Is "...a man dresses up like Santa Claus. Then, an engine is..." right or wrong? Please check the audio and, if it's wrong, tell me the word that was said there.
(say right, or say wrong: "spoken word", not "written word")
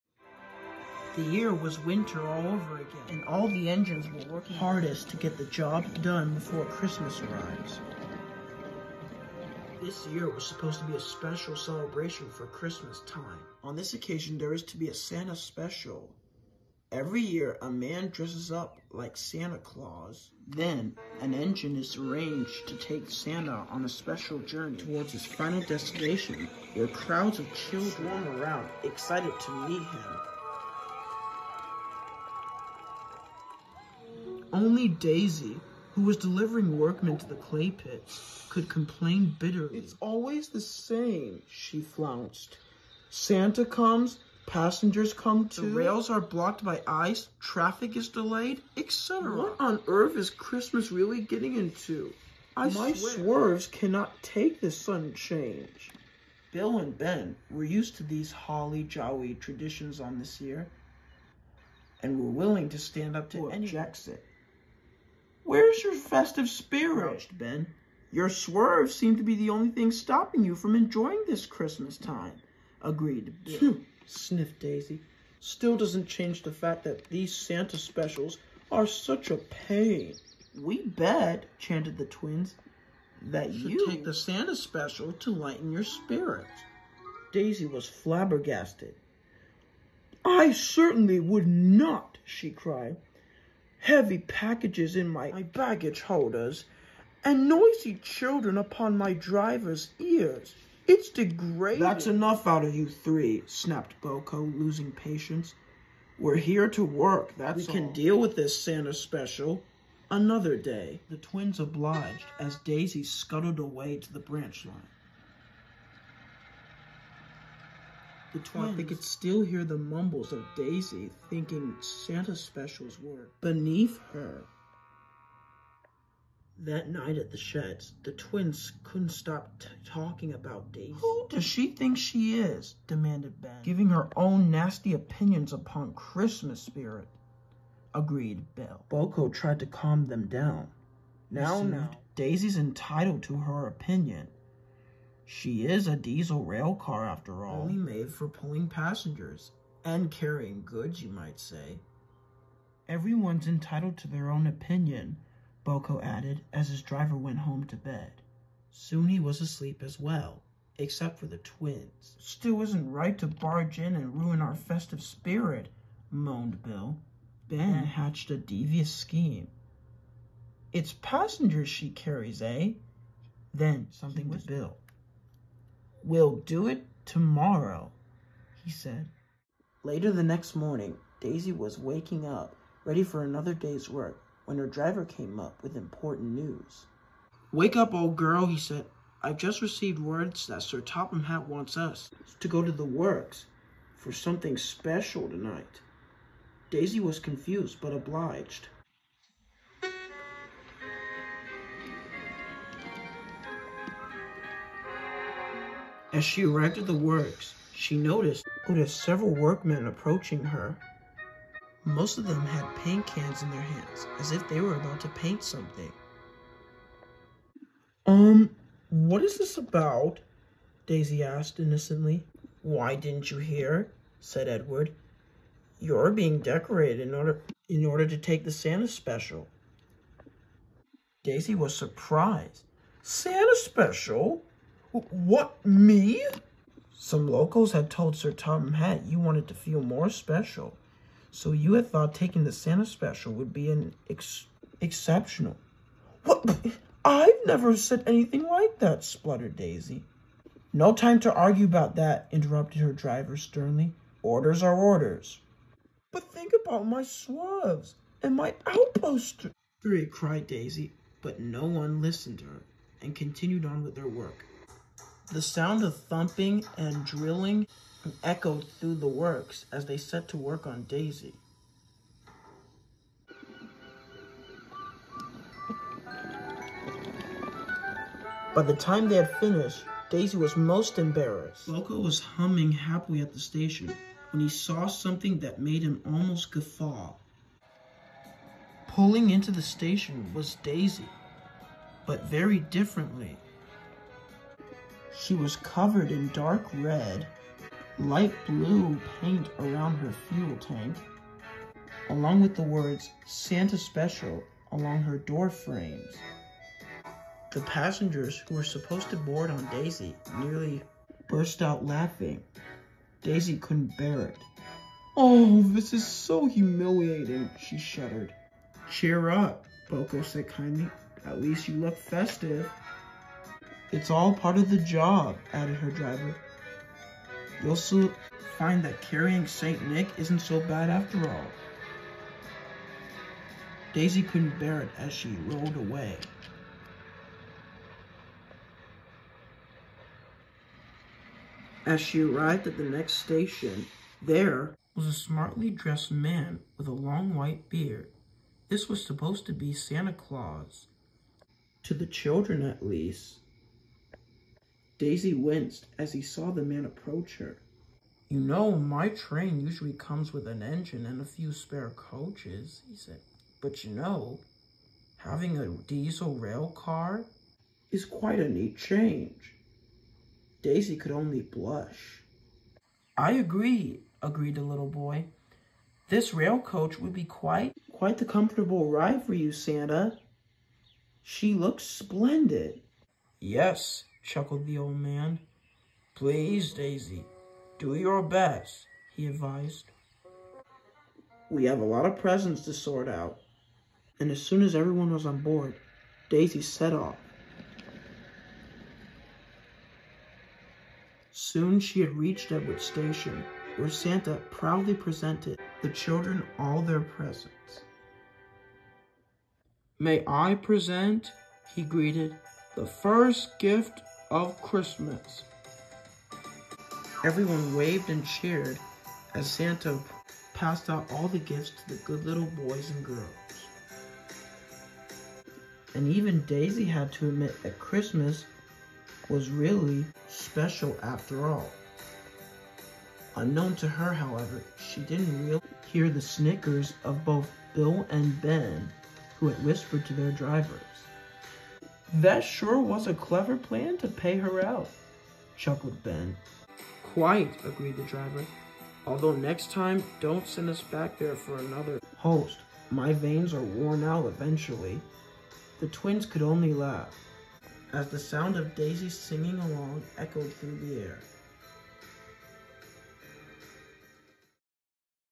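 right.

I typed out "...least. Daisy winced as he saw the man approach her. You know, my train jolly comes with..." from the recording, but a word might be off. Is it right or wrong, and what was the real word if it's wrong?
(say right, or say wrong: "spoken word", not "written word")
wrong: "usually", not "jolly".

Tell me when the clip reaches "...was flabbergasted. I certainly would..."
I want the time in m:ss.
1:27.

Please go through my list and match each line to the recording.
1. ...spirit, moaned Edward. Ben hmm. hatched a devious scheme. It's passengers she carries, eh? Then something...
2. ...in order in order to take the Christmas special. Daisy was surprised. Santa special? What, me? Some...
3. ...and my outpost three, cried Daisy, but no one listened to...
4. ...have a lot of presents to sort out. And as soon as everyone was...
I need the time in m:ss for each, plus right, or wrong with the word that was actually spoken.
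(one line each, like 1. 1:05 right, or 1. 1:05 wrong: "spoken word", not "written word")
1. 2:45 wrong: "Bill", not "Edward"
2. 3:47 wrong: "Santa", not "Christmas"
3. 4:18 right
4. 6:31 right.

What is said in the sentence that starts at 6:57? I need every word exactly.
Everyone waved and cheered as Santa passed out all the gifts to the good little boys and girls.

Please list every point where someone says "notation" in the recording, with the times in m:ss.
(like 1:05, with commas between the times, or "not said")
not said.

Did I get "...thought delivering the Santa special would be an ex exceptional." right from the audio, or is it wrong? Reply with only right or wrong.
wrong.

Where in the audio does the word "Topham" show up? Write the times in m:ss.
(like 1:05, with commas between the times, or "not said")
3:10, 3:58.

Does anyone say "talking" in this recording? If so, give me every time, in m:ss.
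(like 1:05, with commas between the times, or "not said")
2:09.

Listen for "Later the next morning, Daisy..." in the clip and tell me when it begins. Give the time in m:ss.
2:59.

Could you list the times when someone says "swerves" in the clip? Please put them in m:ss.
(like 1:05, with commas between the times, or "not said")
0:53, 1:08.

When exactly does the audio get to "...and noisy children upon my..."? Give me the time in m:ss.
1:37.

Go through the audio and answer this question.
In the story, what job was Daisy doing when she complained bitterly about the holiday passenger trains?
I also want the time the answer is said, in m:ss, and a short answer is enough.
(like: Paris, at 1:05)
Delivering workmen to the clay pits, at 0:36.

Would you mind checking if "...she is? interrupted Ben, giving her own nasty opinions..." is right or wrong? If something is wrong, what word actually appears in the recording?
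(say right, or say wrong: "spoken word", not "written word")
wrong: "demanded", not "interrupted".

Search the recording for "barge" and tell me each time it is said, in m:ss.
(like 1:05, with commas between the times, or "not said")
2:43.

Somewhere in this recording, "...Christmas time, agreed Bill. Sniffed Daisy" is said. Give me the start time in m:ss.
1:11.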